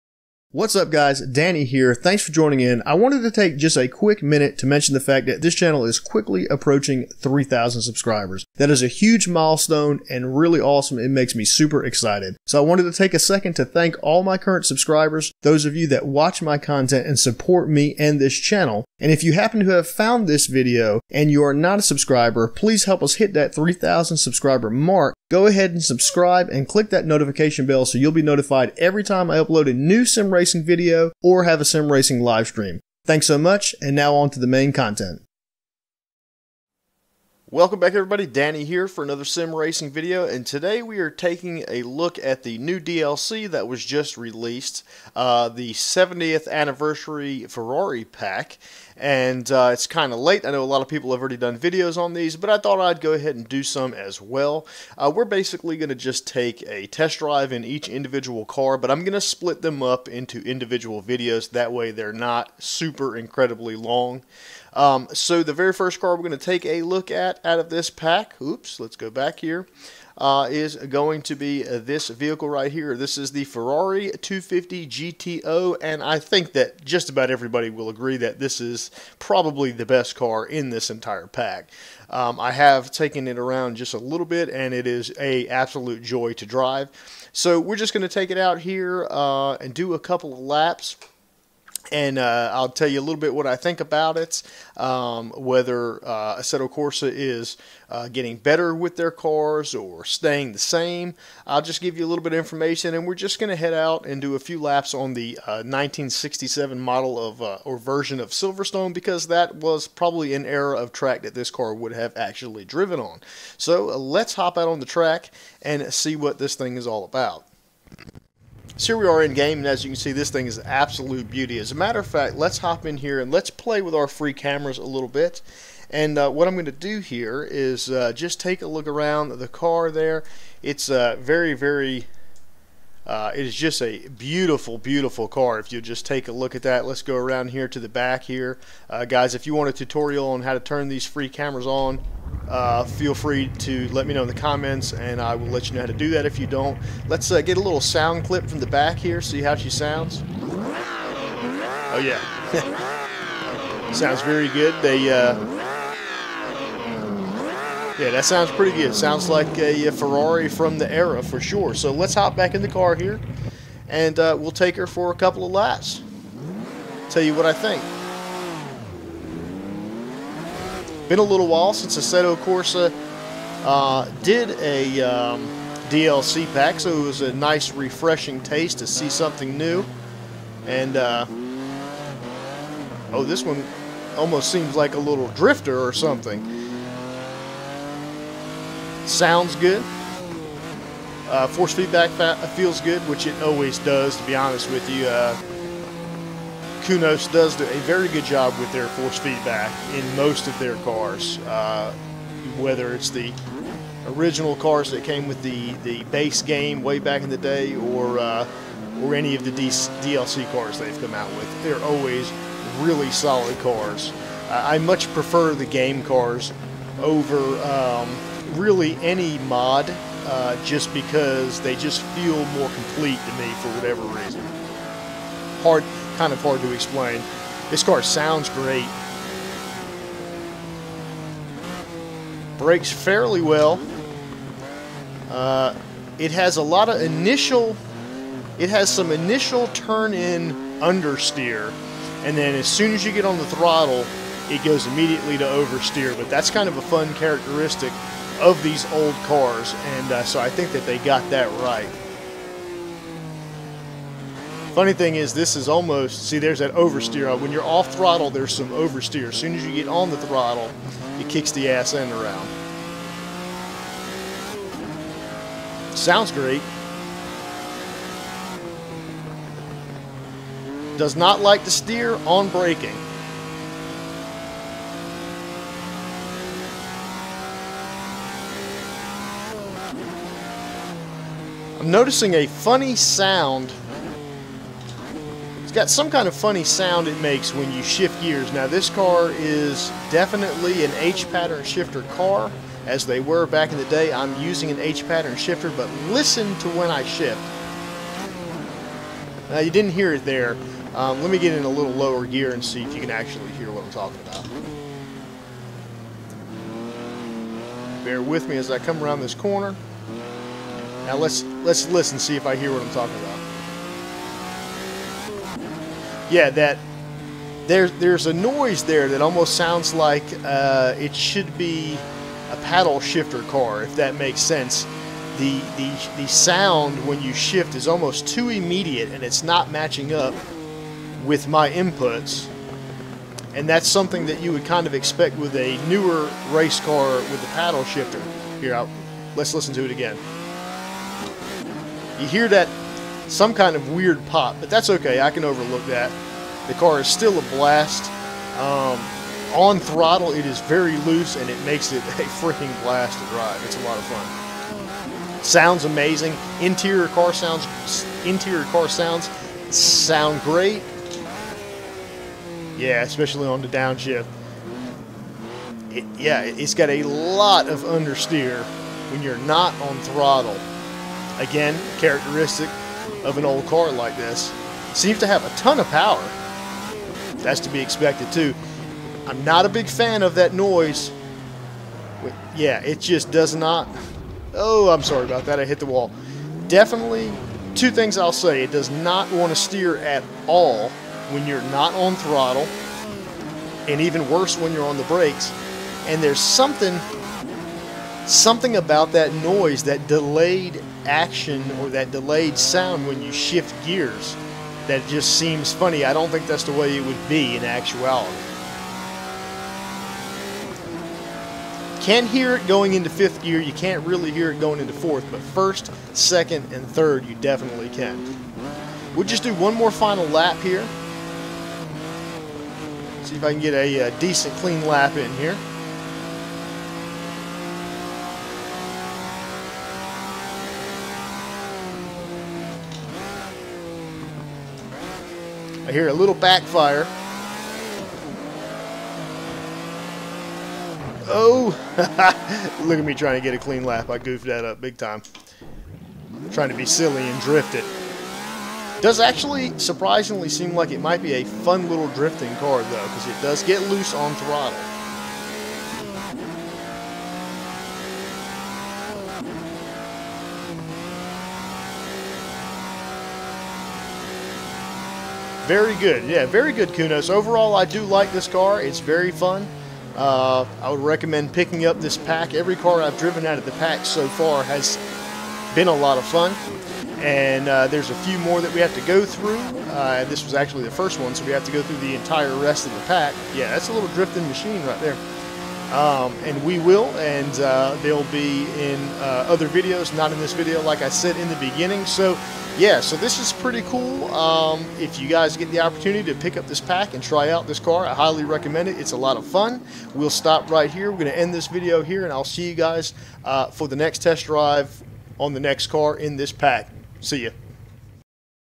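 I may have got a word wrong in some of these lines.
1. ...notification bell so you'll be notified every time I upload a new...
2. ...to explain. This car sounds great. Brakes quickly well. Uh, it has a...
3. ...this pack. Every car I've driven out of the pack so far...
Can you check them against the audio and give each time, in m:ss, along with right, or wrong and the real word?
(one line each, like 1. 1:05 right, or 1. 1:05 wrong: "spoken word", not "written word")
1. 0:27 right
2. 3:46 wrong: "fairly", not "quickly"
3. 7:52 right.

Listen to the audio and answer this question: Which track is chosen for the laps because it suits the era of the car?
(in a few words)
Silverstone.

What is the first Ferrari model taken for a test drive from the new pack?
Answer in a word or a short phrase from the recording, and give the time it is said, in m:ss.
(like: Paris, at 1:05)
Ferrari 250 GTO, at 1:13.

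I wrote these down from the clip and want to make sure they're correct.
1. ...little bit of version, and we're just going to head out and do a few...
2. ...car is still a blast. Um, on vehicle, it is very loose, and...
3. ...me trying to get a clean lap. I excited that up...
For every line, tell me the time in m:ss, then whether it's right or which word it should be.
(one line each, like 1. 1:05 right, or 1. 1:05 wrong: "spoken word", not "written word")
1. 1:42 wrong: "information", not "version"
2. 5:46 wrong: "throttle", not "vehicle"
3. 7:23 wrong: "goofed", not "excited".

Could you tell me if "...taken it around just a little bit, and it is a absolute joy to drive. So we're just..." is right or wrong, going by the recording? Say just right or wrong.
right.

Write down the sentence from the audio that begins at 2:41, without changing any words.
So let's hop back in the car here, and uh, we'll take her for a couple of laps.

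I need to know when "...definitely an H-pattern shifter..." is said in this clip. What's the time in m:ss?
4:50.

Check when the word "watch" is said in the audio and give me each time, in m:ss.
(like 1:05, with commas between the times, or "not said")
0:16.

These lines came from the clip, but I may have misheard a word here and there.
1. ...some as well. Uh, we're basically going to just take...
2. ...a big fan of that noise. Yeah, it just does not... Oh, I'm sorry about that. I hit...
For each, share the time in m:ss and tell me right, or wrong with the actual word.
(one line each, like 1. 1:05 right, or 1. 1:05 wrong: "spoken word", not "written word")
1. 0:53 right
2. 6:19 right.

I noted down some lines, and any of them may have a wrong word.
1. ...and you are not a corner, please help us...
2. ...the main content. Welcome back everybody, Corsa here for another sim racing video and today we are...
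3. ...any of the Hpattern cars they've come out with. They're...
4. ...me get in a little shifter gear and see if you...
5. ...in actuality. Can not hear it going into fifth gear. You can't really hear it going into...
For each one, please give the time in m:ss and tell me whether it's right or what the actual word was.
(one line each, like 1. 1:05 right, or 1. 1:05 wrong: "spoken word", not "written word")
1. 0:21 wrong: "subscriber", not "corner"
2. 0:34 wrong: "Danny", not "Corsa"
3. 3:29 wrong: "DLC", not "Hpattern"
4. 5:01 wrong: "lower", not "shifter"
5. 6:47 right.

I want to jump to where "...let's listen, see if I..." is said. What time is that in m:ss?
5:11.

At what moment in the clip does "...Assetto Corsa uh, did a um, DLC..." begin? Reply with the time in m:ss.
2:51.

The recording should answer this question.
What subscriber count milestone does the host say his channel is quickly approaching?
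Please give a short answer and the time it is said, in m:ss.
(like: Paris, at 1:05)
3,000, at 0:07.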